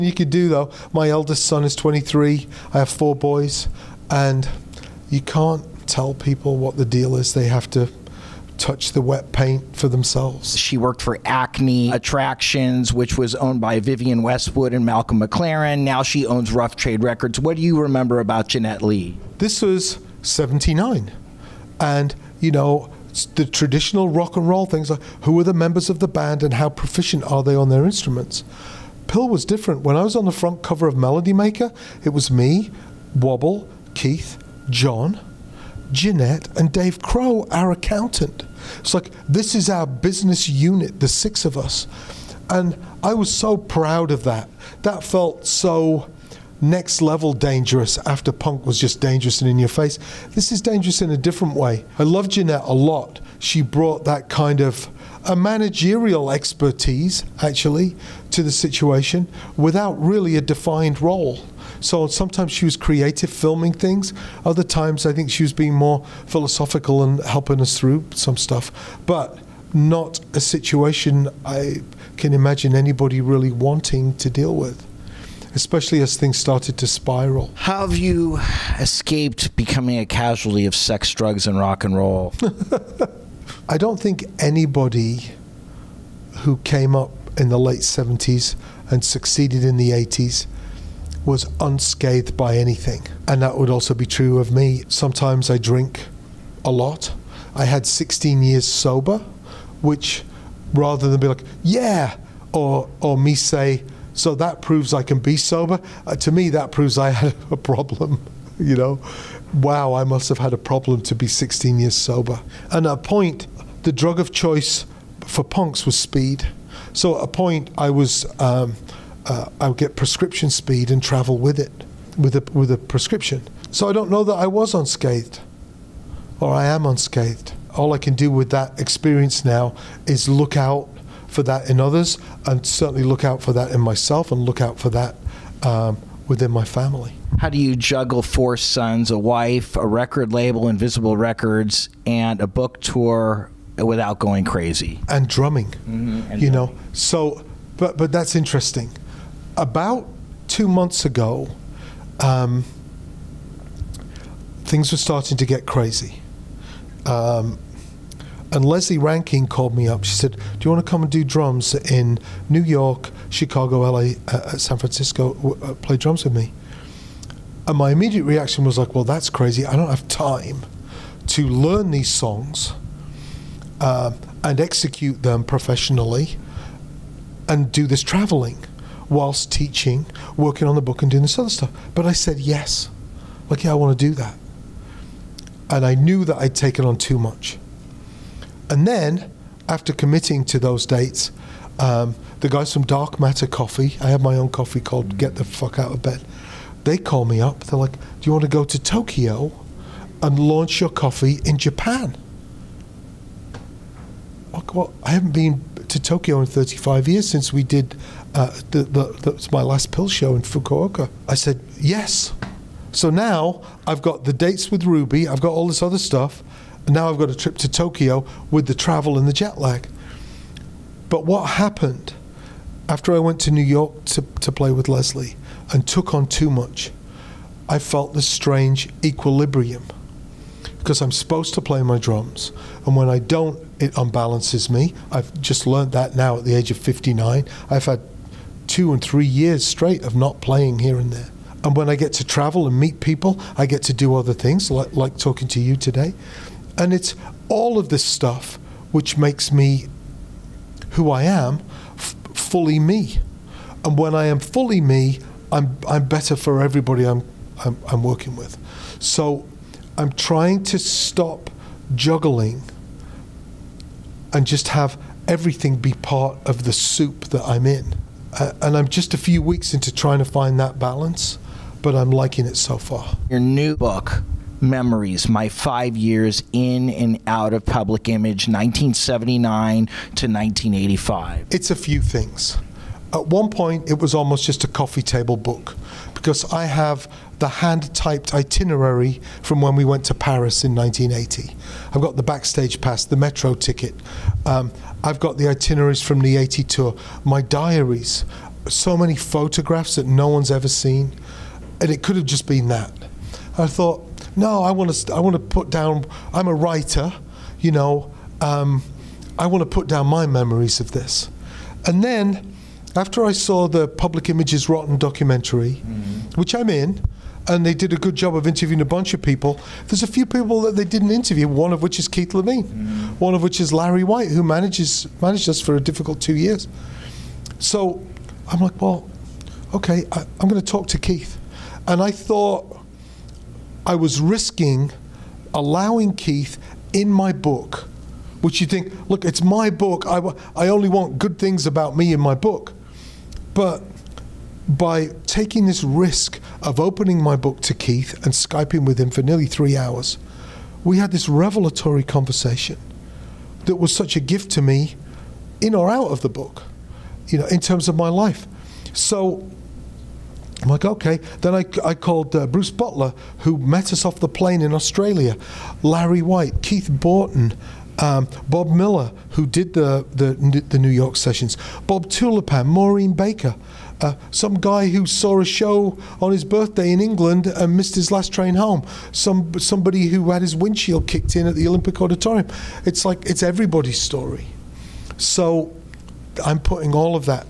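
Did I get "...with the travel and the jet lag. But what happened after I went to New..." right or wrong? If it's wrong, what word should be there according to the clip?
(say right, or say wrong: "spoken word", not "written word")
right.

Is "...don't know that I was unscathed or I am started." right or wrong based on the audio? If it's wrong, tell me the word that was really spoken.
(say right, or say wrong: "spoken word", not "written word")
wrong: "unscathed", not "started".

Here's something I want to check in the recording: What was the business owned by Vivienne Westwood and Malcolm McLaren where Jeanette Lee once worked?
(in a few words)
Acme Attractions.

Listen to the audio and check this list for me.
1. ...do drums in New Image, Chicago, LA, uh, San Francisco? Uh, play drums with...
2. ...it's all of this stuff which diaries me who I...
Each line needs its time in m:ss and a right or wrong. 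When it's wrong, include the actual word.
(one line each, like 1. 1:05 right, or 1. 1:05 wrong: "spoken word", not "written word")
1. 2:41 wrong: "York", not "Image"
2. 4:06 wrong: "makes", not "diaries".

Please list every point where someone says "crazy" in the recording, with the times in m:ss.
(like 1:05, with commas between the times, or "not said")
2:24, 2:35, 2:49.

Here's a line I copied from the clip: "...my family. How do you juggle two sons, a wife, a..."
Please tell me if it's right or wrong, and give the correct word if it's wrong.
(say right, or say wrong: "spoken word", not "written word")
wrong: "four", not "two".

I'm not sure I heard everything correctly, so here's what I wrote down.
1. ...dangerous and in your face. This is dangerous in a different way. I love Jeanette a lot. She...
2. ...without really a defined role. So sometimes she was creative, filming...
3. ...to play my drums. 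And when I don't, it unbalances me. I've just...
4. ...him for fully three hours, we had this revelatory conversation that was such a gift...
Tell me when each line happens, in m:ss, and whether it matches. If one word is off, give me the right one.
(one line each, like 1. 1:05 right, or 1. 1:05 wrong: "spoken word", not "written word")
1. 0:48 right
2. 0:59 right
3. 3:51 right
4. 5:48 wrong: "nearly", not "fully".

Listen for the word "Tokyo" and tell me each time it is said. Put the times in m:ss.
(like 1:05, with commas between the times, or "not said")
3:18, 3:25, 3:37.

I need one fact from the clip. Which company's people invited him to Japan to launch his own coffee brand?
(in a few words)
Dark Matter Coffee.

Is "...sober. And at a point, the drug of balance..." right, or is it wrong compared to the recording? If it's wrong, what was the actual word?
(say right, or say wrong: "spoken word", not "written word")
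wrong: "choice", not "balance".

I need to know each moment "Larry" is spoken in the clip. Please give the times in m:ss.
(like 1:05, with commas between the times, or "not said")
5:23, 6:05.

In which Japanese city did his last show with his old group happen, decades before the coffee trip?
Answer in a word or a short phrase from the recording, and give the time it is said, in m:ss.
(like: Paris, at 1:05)
Fukuoka, at 3:30.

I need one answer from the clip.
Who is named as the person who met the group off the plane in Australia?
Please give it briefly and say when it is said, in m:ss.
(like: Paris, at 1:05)
Bruce Butler, at 6:02.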